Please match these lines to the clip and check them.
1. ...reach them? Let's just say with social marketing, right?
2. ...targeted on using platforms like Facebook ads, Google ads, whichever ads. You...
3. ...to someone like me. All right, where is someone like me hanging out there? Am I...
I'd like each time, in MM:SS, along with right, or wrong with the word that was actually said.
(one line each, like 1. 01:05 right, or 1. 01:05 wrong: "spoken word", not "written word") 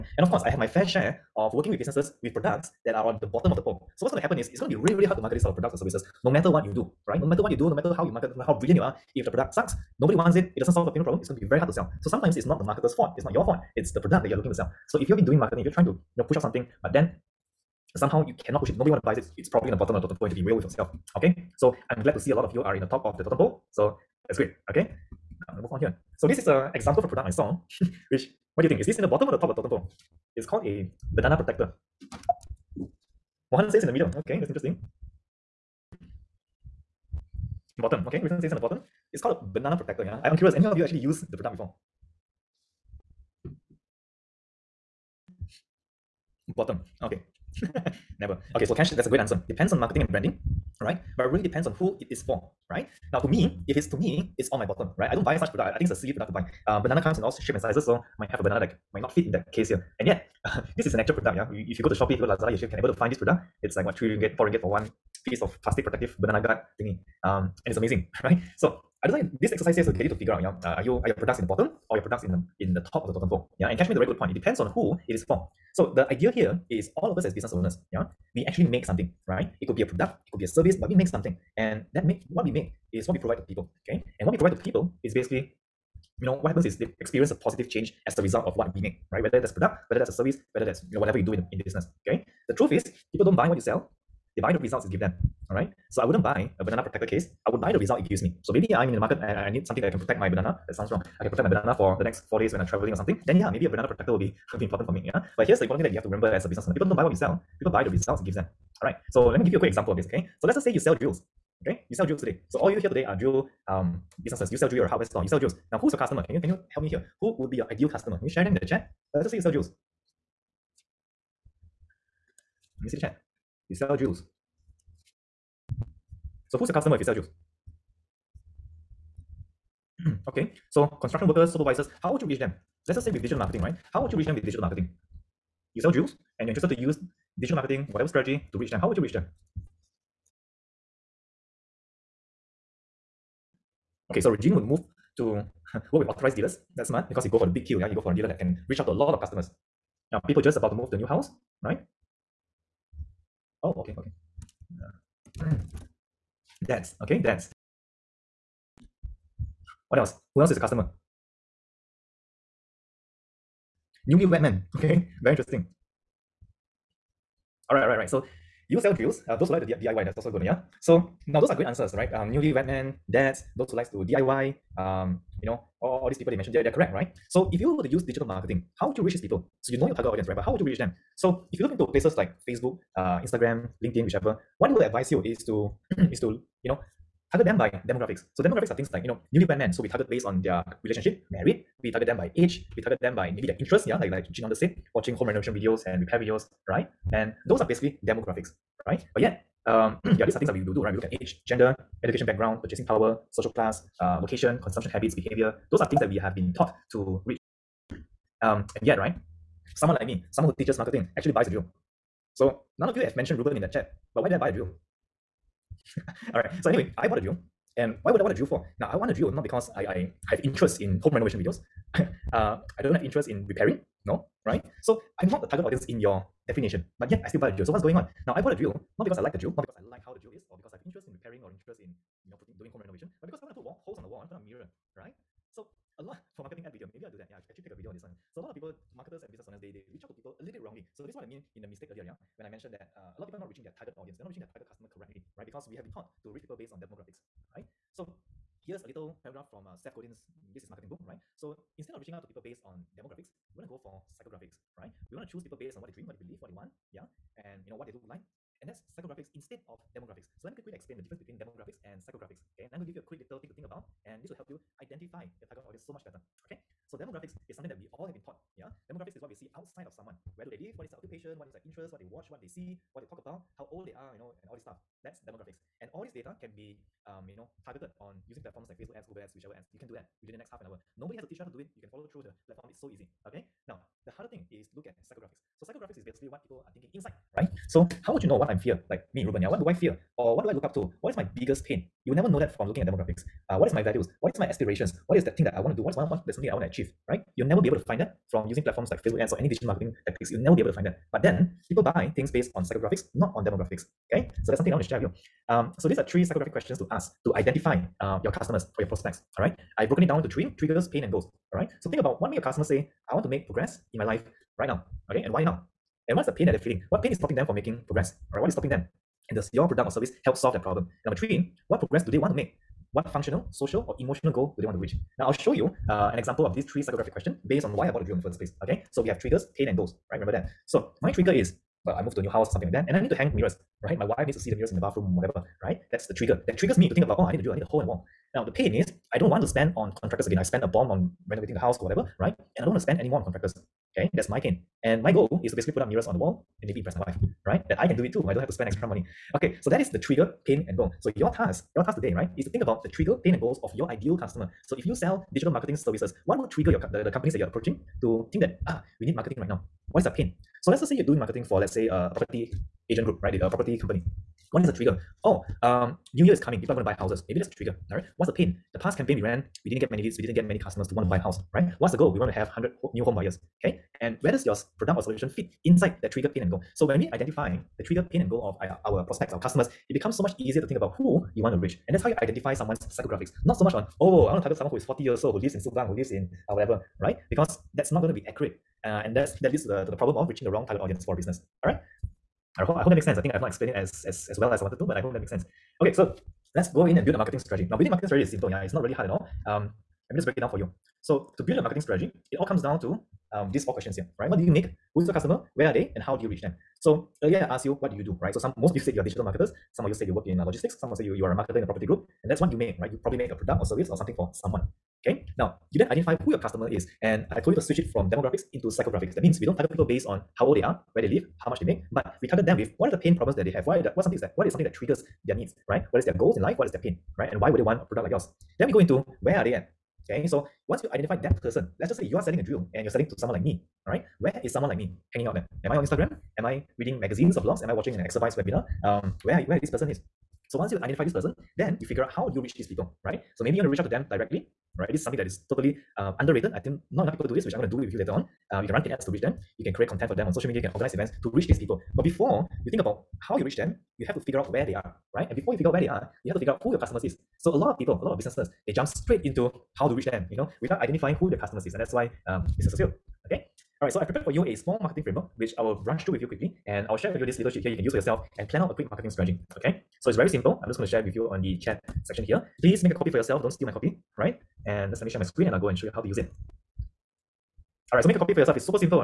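1. 02:12 wrong: "digital", not "social"
2. 04:37 right
3. 07:13 right.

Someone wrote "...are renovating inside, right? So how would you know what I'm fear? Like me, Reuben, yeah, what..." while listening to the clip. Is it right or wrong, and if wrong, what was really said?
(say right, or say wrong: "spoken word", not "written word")
wrong: "thinking", not "renovating".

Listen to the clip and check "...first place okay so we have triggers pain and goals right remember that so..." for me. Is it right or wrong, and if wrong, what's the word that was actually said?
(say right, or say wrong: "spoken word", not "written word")
right.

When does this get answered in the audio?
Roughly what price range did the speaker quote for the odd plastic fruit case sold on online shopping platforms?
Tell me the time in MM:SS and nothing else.
01:03.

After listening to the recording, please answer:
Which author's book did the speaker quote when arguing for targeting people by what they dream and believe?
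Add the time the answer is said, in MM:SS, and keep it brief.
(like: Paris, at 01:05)
Seth Godin, at 04:09.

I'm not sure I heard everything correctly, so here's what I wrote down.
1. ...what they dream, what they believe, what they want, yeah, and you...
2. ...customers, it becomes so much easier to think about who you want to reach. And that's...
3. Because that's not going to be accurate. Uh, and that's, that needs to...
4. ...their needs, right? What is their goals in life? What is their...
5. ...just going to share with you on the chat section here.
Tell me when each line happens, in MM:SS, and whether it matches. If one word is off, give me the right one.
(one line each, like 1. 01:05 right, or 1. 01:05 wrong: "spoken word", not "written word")
1. 04:15 right
2. 06:19 right
3. 06:27 wrong: "leads", not "needs"
4. 07:05 right
5. 07:50 right.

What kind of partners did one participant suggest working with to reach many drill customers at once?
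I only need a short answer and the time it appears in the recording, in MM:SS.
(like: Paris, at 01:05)
authorized dealers, at 02:26.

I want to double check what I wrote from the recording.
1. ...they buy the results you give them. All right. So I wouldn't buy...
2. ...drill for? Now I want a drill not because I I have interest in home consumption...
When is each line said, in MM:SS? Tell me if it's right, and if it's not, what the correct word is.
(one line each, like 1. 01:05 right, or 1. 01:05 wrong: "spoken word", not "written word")
1. 01:34 right
2. 03:38 wrong: "renovation", not "consumption".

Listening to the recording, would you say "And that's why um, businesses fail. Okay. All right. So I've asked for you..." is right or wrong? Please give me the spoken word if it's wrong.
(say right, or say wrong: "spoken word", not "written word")
wrong: "prepared", not "asked".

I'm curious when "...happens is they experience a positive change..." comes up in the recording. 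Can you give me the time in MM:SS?
01:26.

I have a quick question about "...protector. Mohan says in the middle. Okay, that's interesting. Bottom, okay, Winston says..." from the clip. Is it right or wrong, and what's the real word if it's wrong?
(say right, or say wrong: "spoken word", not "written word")
right.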